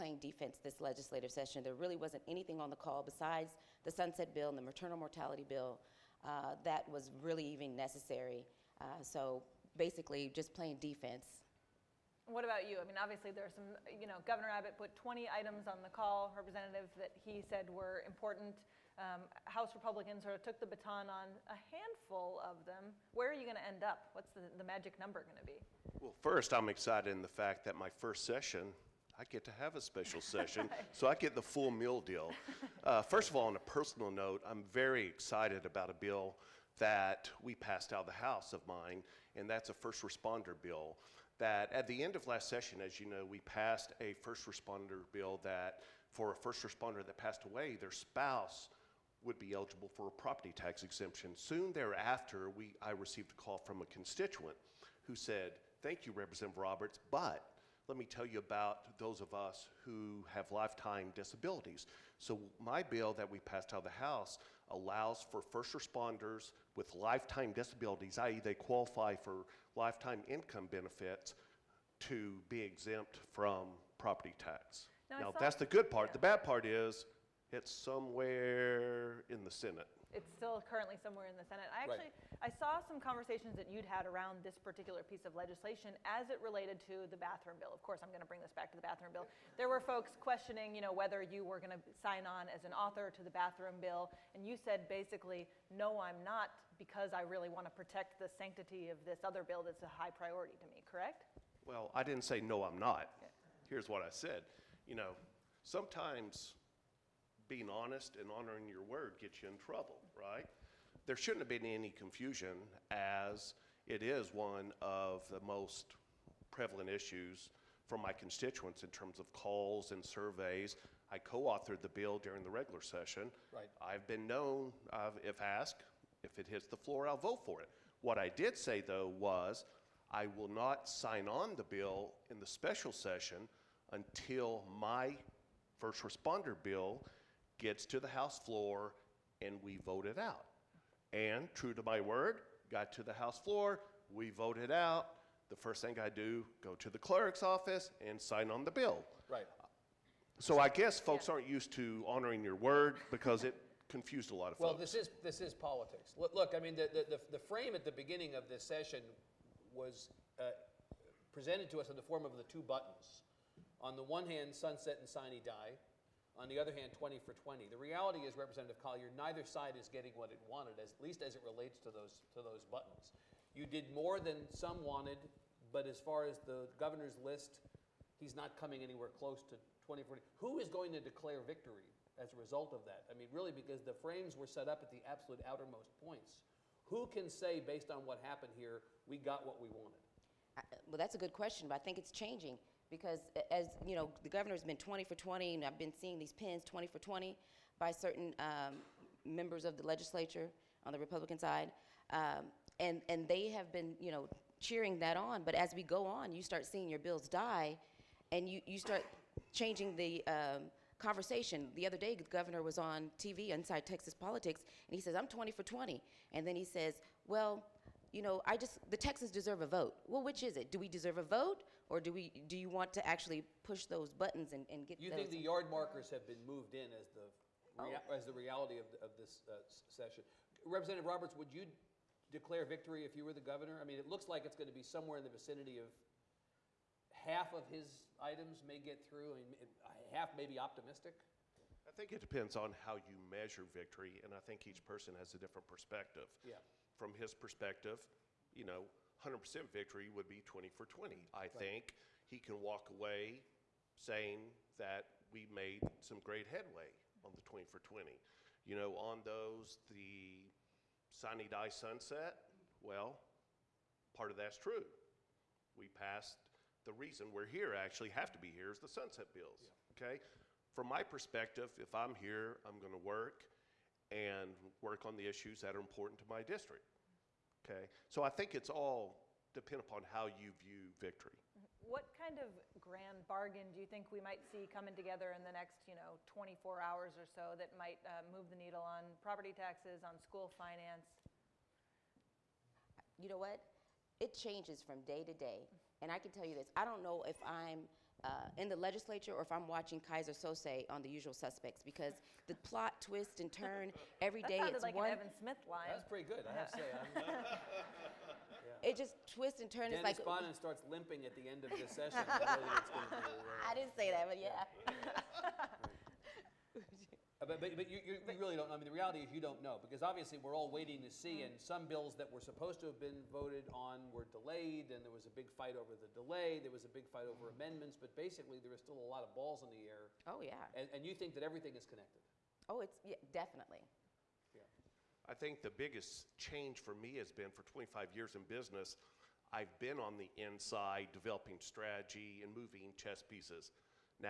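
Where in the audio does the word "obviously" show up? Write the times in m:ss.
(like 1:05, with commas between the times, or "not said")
0:12, 5:20.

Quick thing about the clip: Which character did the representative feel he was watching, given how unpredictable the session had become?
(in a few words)
Keyser Söze.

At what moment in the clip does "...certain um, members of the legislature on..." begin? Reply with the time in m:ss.
3:17.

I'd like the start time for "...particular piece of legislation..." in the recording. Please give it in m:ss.
1:24.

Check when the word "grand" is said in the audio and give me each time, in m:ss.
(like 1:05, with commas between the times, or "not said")
4:42.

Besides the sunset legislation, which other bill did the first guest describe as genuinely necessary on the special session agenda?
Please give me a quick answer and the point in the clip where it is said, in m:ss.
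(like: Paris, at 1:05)
Maternal mortality bill, at 0:04.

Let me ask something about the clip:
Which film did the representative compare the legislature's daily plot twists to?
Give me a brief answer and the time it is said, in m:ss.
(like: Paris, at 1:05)
The Usual Suspects, at 5:01.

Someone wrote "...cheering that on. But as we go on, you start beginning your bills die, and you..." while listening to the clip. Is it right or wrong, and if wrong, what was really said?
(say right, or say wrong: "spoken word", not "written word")
wrong: "seeing", not "beginning".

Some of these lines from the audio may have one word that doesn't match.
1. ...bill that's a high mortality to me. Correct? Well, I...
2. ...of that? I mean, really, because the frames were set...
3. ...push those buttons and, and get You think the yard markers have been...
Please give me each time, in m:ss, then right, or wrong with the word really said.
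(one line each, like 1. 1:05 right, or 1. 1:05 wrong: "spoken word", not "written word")
1. 1:39 wrong: "priority", not "mortality"
2. 3:02 right
3. 3:43 right.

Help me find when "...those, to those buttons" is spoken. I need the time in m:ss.
2:51.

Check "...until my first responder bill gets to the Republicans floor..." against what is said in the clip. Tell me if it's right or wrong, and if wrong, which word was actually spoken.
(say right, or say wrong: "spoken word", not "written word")
wrong: "House", not "Republicans".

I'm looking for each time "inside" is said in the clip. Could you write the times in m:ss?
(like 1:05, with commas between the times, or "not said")
3:33, 5:40.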